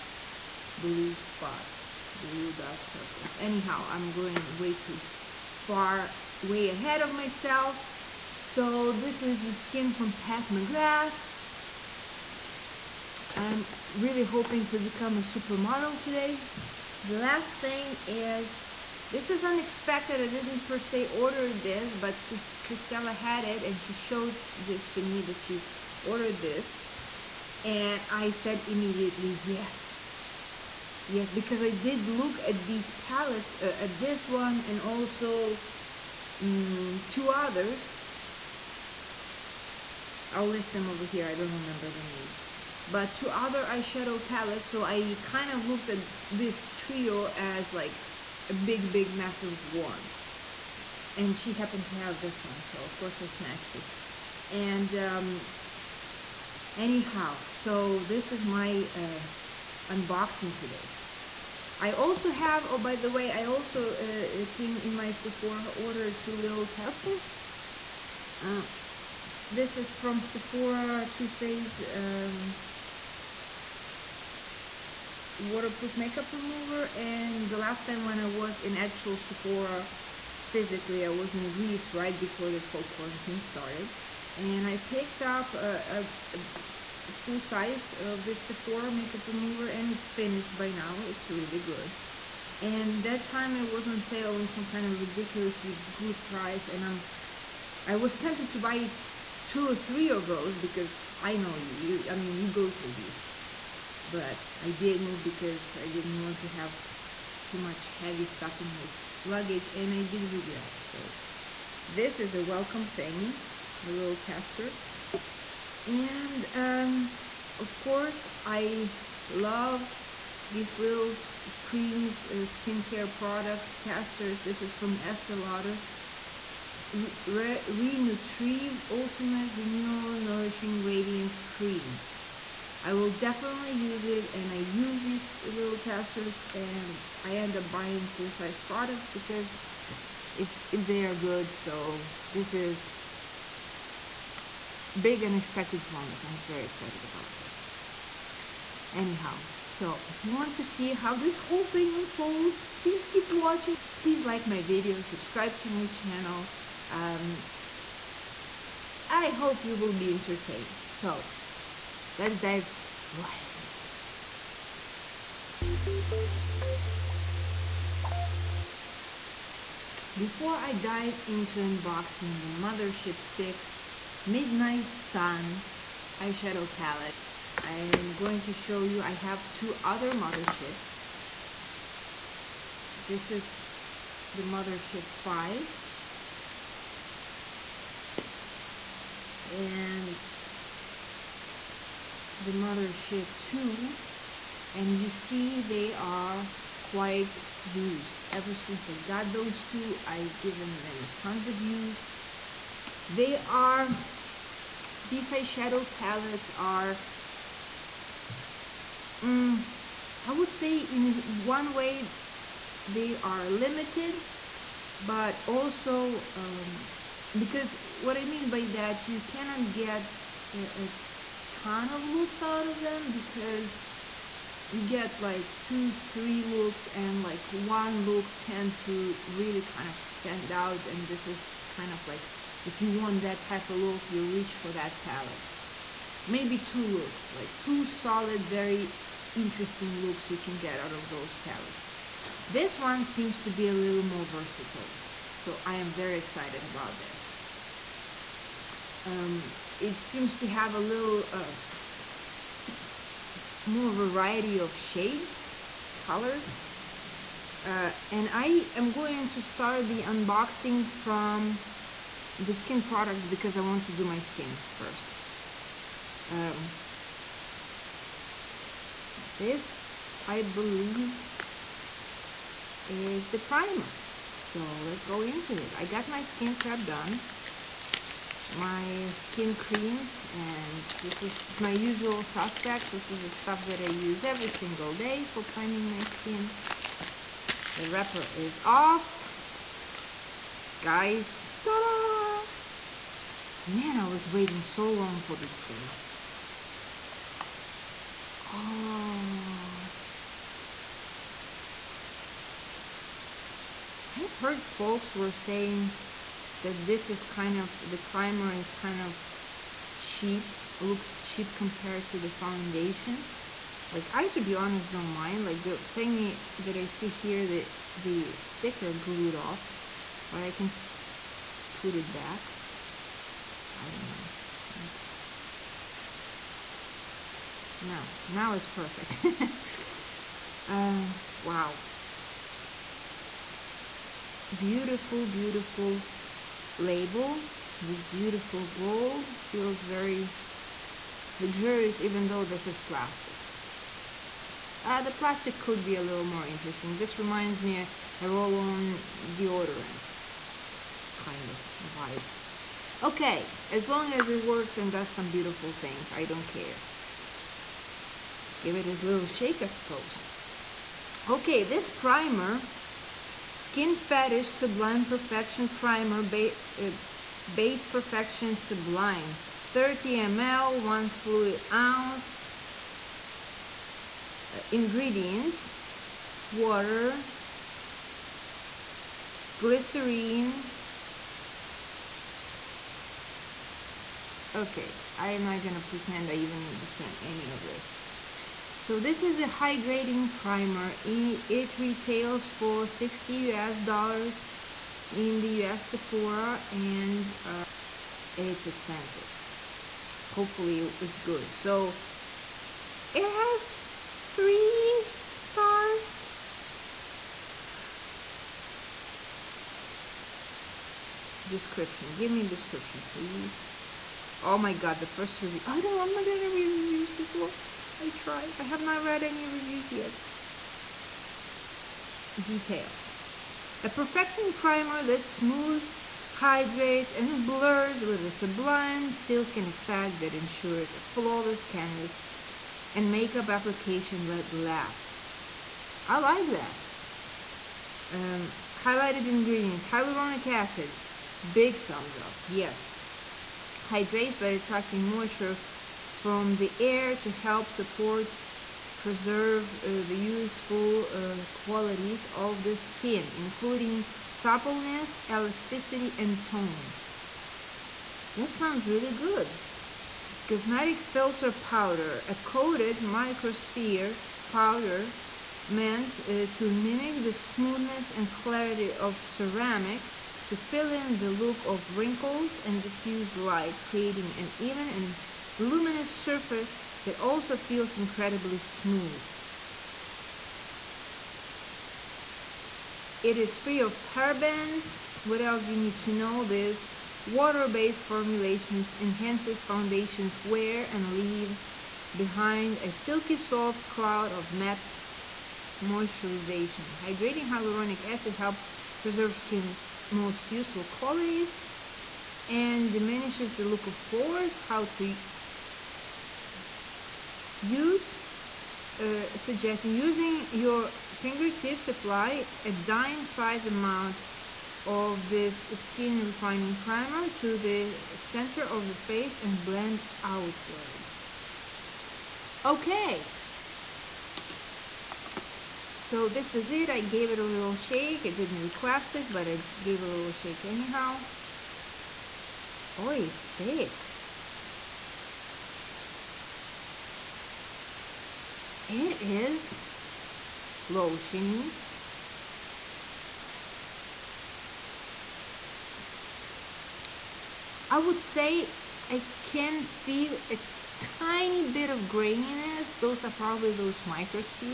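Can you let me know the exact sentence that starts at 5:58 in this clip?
Let's give it a little shake, I suppose.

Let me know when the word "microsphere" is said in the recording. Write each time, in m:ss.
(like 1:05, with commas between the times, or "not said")
7:43, 9:14.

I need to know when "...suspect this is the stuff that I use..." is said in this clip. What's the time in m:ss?
4:42.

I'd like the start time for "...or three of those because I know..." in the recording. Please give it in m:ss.
1:39.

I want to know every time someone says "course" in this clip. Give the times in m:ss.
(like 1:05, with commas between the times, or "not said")
0:52, 1:57.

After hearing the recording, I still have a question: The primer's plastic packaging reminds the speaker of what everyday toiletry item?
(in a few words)
roll-on deodorant.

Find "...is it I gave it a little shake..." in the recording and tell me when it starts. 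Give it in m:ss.
8:46.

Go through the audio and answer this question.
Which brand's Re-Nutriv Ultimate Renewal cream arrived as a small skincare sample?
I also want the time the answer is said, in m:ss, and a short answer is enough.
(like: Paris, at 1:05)
Estee Lauder, at 2:05.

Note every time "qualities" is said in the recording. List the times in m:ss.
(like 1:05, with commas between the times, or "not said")
7:31, 8:20.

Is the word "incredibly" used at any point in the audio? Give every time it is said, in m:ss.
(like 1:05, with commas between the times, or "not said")
7:57.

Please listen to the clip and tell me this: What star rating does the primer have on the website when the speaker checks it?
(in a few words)
3 stars.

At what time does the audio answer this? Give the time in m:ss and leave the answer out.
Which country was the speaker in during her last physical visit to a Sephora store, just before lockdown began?
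1:21.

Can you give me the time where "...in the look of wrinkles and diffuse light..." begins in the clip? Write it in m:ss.
7:50.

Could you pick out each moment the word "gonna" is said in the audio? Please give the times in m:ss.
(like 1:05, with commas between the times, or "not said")
6:25, 6:56.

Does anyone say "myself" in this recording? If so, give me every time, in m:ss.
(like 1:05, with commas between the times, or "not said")
0:07.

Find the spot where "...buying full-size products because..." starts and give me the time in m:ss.
2:17.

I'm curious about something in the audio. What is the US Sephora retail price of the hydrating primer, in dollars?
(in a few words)
60 US dollars.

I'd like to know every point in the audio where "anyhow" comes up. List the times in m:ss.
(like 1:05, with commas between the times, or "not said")
0:03, 0:56, 2:28, 8:50.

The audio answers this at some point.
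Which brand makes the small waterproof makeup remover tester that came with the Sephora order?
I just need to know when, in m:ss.
1:11.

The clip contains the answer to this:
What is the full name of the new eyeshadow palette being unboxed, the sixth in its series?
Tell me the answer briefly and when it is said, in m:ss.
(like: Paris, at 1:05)
Mothership 6 Midnight Sun, at 2:52.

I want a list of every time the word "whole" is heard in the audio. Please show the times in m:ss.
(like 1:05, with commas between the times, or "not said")
1:22, 2:31.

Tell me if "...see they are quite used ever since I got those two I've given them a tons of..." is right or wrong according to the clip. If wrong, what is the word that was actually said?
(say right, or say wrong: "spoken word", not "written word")
right.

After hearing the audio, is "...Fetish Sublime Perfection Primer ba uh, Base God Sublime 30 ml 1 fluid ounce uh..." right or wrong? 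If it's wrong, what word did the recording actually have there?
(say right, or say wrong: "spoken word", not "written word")
wrong: "Perfection", not "God".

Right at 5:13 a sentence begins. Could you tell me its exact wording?
Like I, to be honest, don't mind.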